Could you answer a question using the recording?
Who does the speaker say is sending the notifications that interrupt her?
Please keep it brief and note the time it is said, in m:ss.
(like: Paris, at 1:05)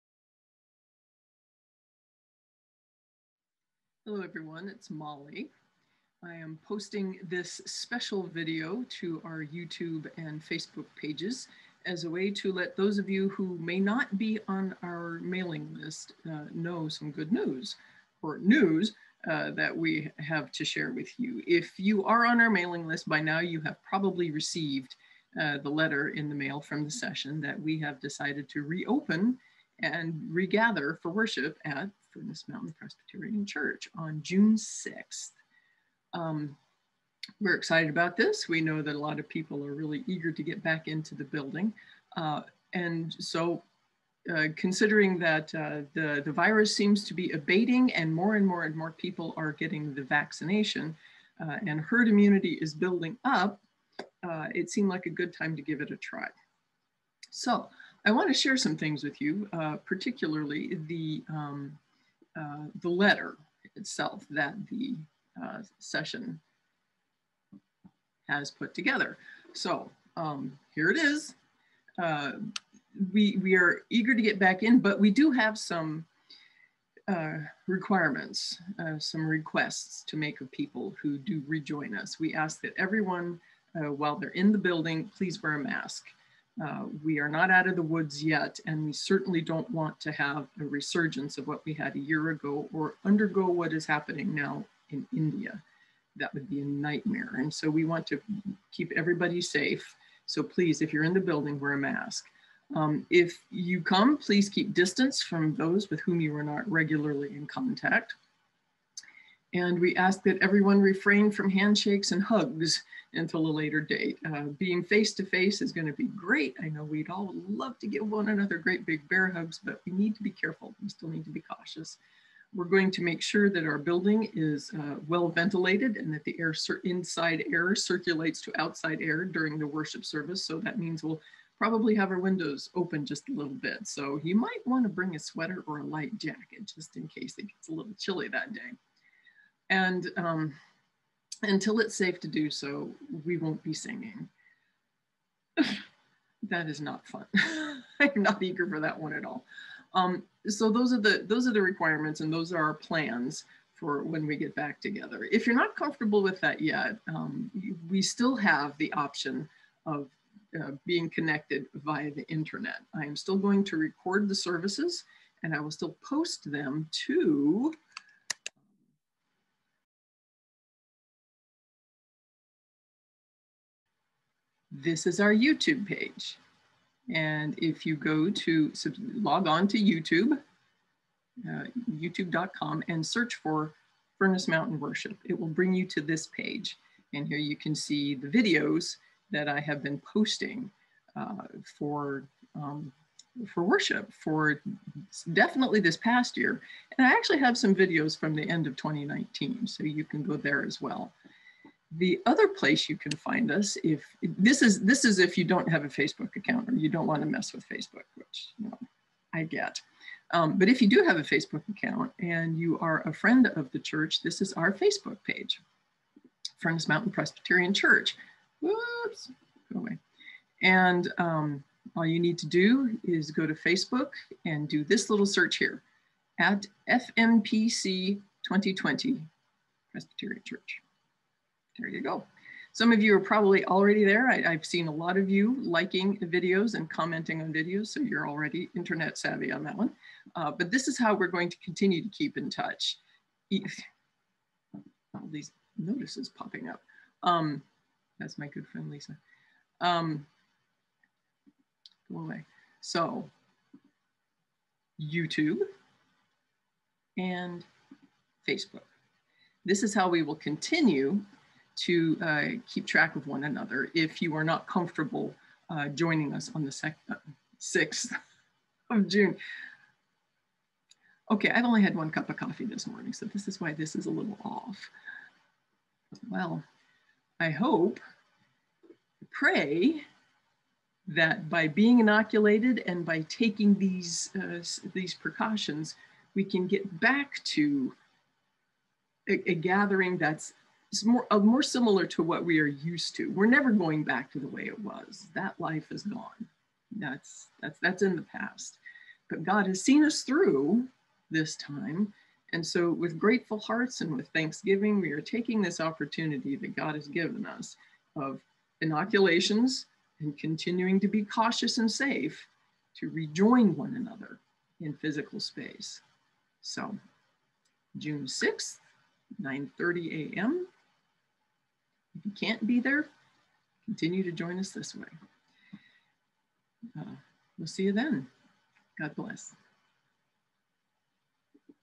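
Lisa, at 4:08.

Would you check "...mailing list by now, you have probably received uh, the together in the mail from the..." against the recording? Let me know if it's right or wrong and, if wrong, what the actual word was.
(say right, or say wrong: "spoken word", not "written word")
wrong: "letter", not "together".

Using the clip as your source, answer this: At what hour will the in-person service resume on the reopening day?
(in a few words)
9:30 a.m.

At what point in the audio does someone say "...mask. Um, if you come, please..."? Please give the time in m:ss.
1:41.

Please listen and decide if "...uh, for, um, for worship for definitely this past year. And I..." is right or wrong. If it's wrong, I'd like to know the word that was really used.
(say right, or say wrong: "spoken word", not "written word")
right.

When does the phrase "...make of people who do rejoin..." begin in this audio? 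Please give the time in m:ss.
1:20.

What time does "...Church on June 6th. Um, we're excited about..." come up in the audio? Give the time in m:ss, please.
0:33.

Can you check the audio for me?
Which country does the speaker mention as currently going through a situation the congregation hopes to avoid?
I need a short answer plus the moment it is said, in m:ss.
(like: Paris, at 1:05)
India, at 1:35.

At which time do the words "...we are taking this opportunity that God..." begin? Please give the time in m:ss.
5:04.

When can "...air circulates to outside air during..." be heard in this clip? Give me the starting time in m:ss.
2:07.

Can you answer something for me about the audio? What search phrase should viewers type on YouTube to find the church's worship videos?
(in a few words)
Furnace Mountain Worship.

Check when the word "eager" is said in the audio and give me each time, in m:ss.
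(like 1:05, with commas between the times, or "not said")
0:40, 1:13, 2:28.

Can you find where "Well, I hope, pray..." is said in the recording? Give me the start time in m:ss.
4:36.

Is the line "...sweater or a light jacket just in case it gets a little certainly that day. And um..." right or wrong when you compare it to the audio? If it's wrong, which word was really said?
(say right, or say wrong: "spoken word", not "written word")
wrong: "chilly", not "certainly".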